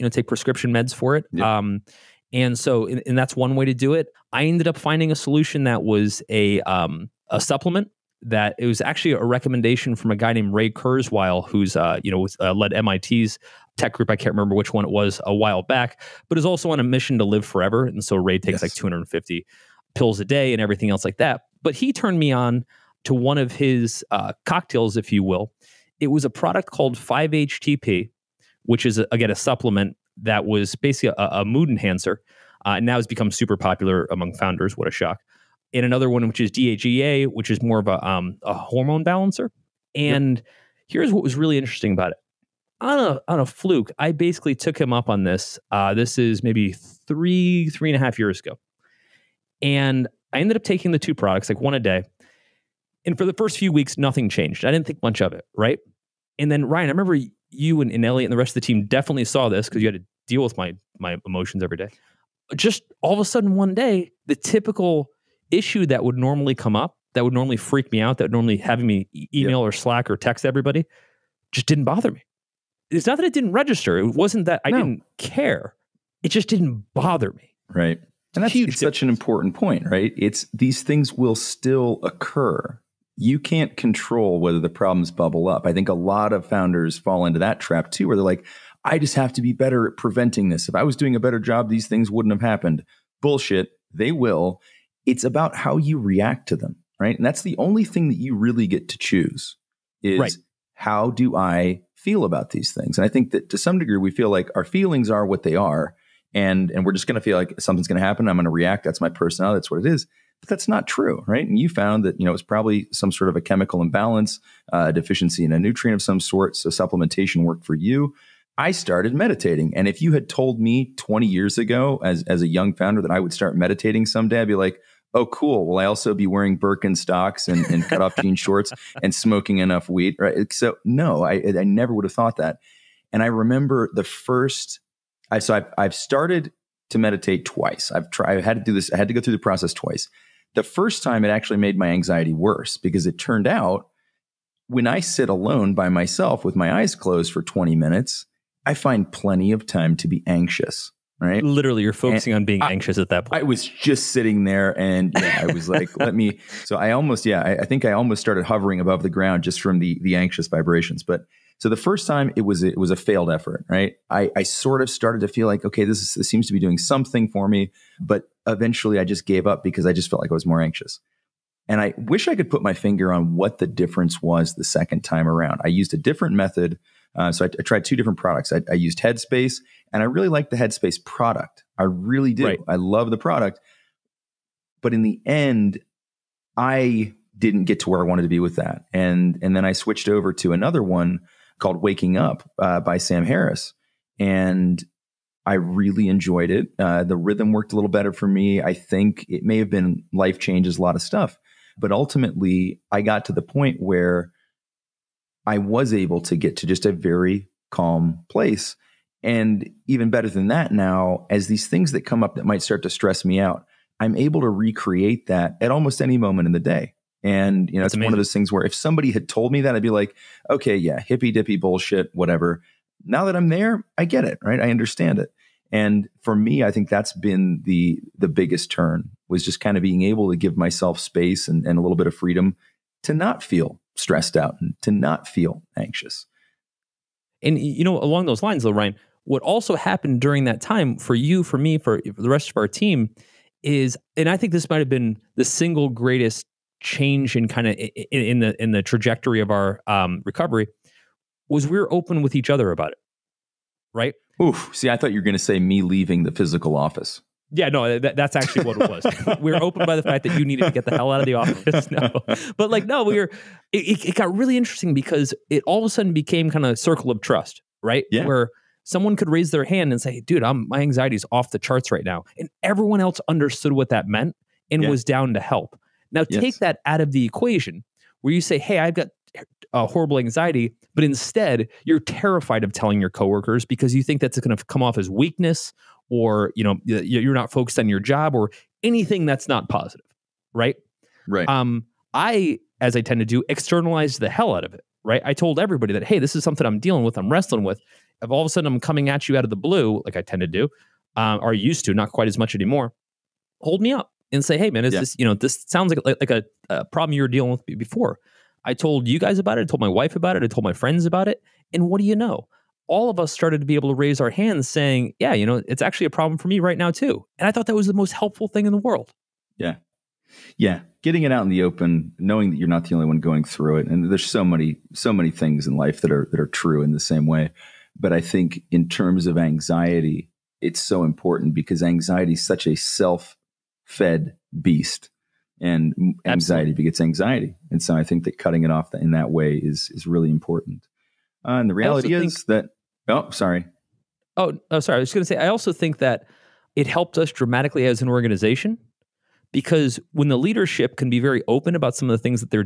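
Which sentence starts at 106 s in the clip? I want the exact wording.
And, and we're just going to feel like something's going to happen.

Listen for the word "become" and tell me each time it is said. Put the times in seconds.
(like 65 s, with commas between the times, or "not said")
33 s.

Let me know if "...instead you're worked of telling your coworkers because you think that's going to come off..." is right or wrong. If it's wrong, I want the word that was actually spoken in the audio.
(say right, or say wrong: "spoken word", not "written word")
wrong: "terrified", not "worked".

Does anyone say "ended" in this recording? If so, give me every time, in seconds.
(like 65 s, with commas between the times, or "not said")
4 s, 50 s.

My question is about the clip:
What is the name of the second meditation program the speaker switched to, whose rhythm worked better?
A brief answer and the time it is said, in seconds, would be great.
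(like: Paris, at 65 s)
Waking Up, at 191 s.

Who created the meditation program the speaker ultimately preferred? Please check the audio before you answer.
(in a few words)
Sam Harris.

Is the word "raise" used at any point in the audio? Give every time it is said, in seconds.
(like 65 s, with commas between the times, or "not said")
269 s, 313 s.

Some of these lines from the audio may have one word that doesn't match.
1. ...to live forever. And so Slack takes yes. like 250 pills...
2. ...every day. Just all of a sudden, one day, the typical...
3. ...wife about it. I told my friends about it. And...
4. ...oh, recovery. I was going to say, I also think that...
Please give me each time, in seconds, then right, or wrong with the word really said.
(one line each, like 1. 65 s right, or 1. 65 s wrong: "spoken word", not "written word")
1. 17 s wrong: "Ray", not "Slack"
2. 61 s right
3. 309 s right
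4. 344 s wrong: "sorry", not "recovery".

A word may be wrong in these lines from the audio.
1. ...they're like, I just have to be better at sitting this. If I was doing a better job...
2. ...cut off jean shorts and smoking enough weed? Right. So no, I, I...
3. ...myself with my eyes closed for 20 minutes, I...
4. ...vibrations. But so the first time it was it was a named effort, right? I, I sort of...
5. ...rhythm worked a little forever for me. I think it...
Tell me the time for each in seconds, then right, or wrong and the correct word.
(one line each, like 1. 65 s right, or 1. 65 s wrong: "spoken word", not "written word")
1. 88 s wrong: "preventing", not "sitting"
2. 127 s right
3. 145 s right
4. 160 s wrong: "failed", not "named"
5. 197 s wrong: "better", not "forever".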